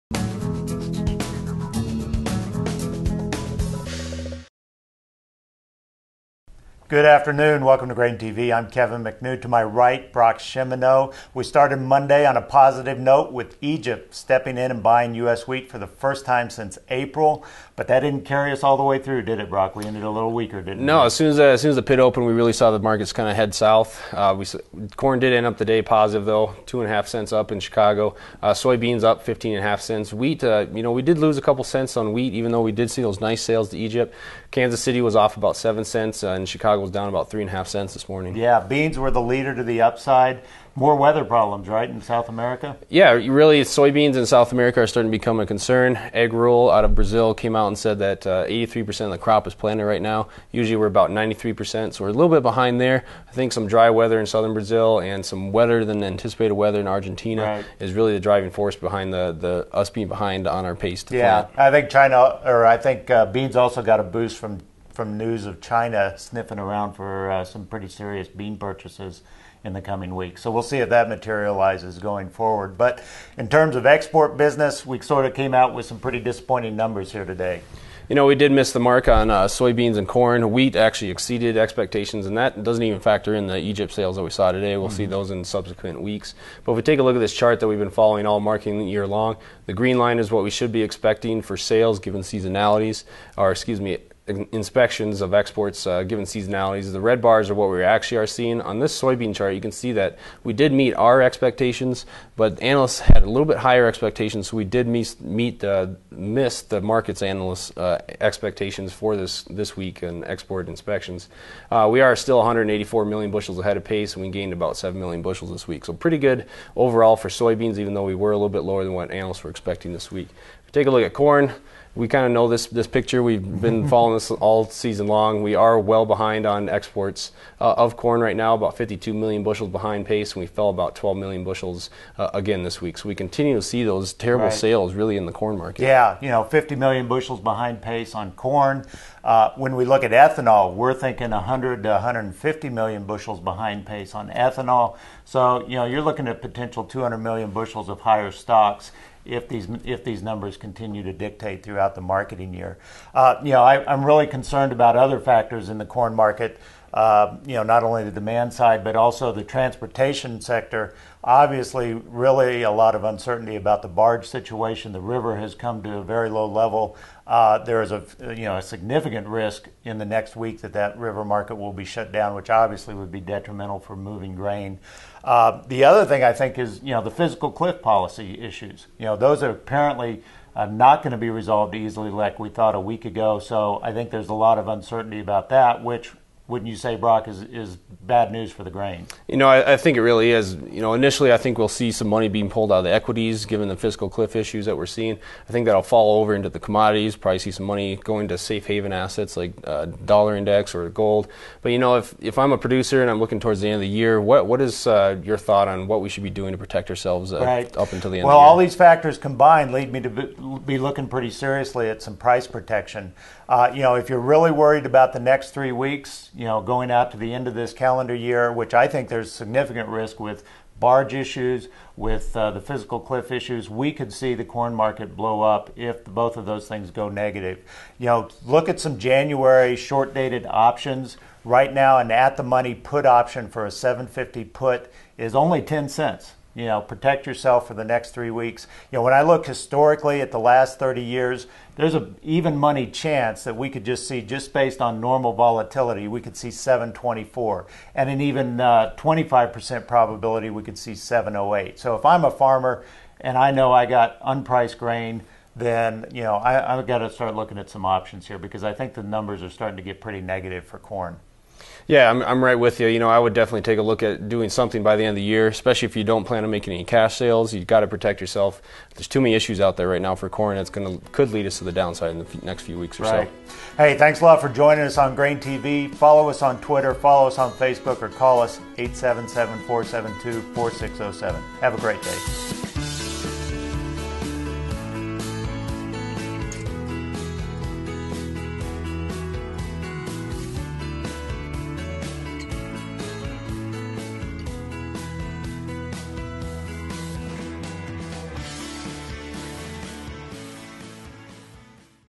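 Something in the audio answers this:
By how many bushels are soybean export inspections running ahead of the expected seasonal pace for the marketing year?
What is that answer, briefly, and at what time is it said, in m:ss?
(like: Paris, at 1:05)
184 million bushels, at 1:52.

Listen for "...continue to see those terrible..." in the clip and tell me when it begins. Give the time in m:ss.
2:13.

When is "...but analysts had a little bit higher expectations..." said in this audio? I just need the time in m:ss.
1:42.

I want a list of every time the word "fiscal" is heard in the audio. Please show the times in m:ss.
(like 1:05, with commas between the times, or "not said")
2:57, 3:13, 3:42.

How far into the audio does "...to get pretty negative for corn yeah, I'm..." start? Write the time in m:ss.
4:19.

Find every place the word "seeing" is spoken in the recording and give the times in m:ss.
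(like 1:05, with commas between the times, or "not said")
1:38, 3:14.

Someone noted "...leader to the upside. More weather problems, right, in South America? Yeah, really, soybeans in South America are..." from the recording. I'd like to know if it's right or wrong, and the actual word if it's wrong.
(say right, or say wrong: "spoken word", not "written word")
right.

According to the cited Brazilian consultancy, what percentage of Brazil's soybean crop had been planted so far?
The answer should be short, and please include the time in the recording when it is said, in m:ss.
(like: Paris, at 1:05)
83%, at 0:48.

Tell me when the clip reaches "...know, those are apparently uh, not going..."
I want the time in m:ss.
2:59.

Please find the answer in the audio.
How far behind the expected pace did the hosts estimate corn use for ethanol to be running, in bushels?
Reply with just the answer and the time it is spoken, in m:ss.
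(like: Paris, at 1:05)
100 to 150 million, at 2:21.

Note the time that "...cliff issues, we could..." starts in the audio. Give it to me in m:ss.
3:43.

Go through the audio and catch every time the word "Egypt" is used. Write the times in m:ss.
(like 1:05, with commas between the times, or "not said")
0:13, 0:33, 1:23.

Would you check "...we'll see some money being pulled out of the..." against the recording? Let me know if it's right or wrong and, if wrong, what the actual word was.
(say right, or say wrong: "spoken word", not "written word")
right.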